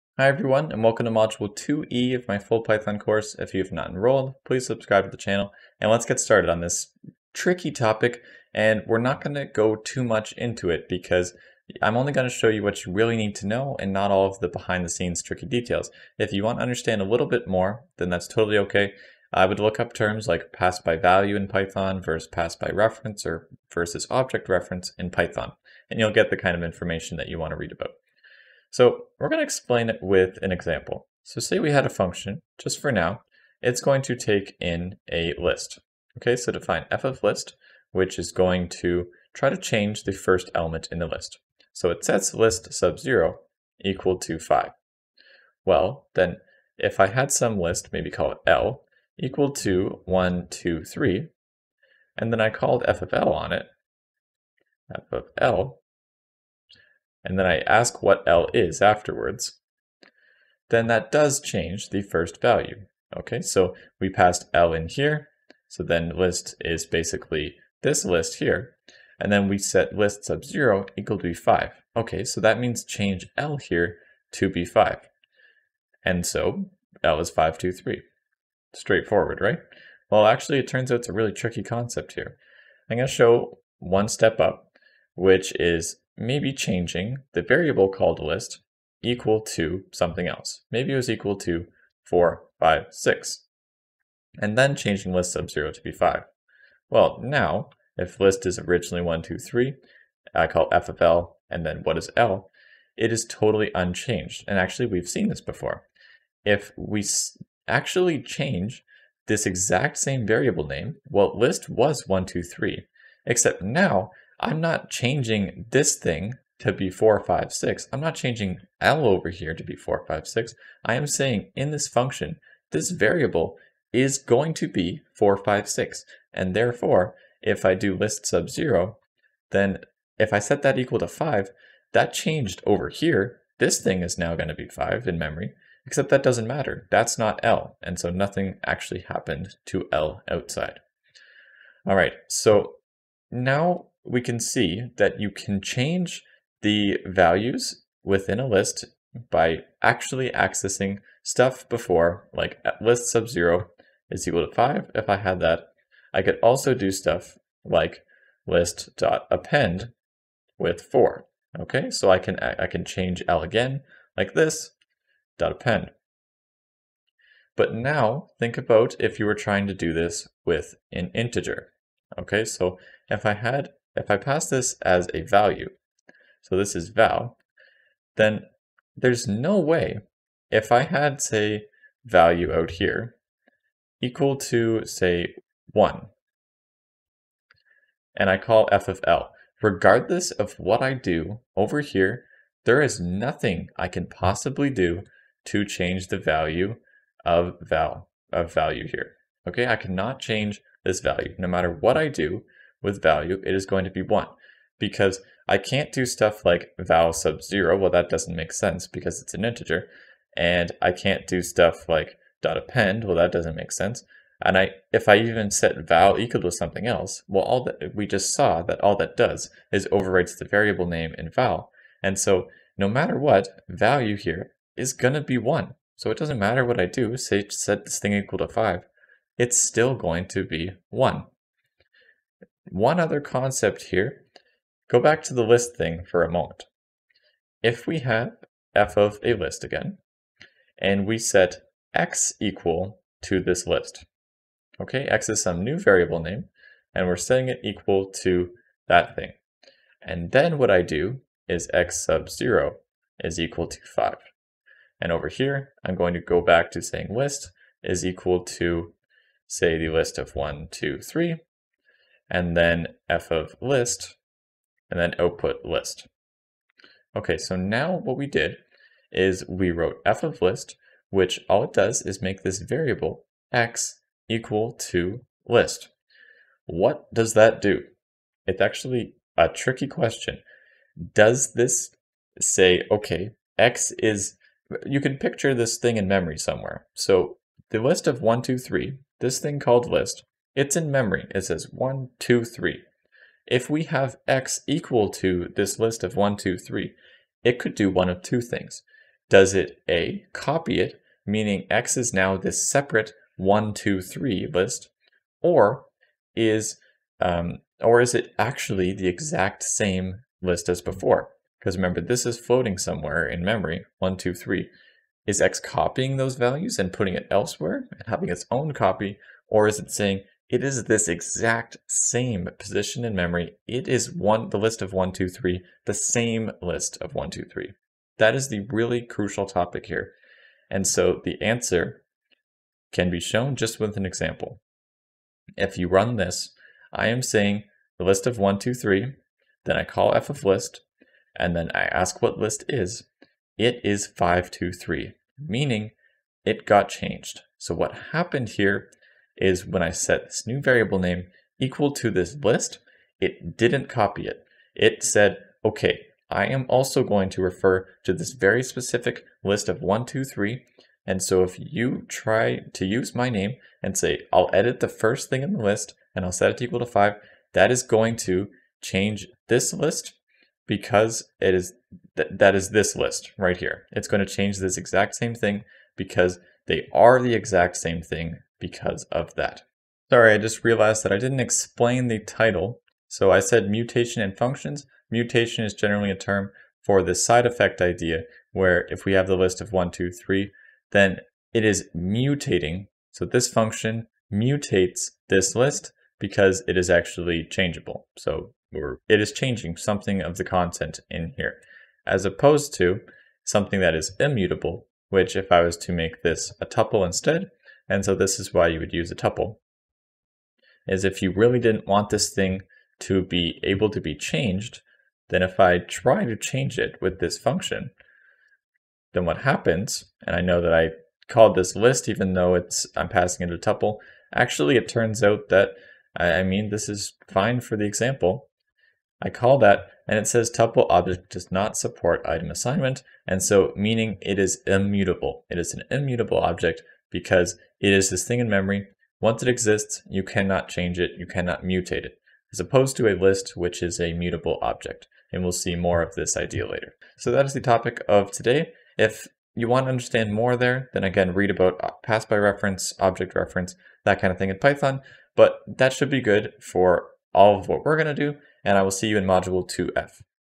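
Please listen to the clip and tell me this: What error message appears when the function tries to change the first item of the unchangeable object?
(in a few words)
tuple object does not support item assignment.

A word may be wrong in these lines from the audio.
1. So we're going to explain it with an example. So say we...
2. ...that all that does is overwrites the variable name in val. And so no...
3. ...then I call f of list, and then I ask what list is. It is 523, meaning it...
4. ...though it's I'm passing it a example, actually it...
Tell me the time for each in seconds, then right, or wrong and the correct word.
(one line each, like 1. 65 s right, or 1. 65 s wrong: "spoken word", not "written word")
1. 28 s right
2. 218 s right
3. 339 s right
4. 422 s wrong: "tuple", not "example".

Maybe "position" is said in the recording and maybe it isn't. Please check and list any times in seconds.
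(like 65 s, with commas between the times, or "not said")
322 s.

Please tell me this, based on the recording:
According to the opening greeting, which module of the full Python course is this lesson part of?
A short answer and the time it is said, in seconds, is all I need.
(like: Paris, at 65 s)
Module 2E, at 1 s.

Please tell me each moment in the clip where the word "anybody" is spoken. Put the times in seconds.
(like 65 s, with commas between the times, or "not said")
not said.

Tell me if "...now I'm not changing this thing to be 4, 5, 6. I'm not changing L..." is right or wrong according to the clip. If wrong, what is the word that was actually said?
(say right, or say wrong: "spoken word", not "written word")
right.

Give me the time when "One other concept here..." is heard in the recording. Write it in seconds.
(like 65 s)
232 s.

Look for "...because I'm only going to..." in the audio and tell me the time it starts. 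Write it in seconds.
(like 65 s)
10 s.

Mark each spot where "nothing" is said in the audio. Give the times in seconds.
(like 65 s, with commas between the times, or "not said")
138 s, 192 s.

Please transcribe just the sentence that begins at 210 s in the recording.
And I can't do stuff like dot append.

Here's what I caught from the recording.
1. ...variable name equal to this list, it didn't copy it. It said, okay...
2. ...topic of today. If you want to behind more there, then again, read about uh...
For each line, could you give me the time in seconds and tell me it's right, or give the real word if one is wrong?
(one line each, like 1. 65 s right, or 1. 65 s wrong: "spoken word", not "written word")
1. 350 s right
2. 447 s wrong: "understand", not "behind".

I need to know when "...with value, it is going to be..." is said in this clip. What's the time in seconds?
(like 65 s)
202 s.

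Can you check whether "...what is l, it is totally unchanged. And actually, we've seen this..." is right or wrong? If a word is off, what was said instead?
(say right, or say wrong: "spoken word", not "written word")
right.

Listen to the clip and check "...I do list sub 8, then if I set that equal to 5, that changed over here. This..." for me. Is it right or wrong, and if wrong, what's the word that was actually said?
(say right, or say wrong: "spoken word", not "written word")
wrong: "0", not "8".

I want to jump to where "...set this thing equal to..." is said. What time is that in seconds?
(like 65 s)
227 s.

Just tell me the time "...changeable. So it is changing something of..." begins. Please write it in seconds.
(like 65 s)
397 s.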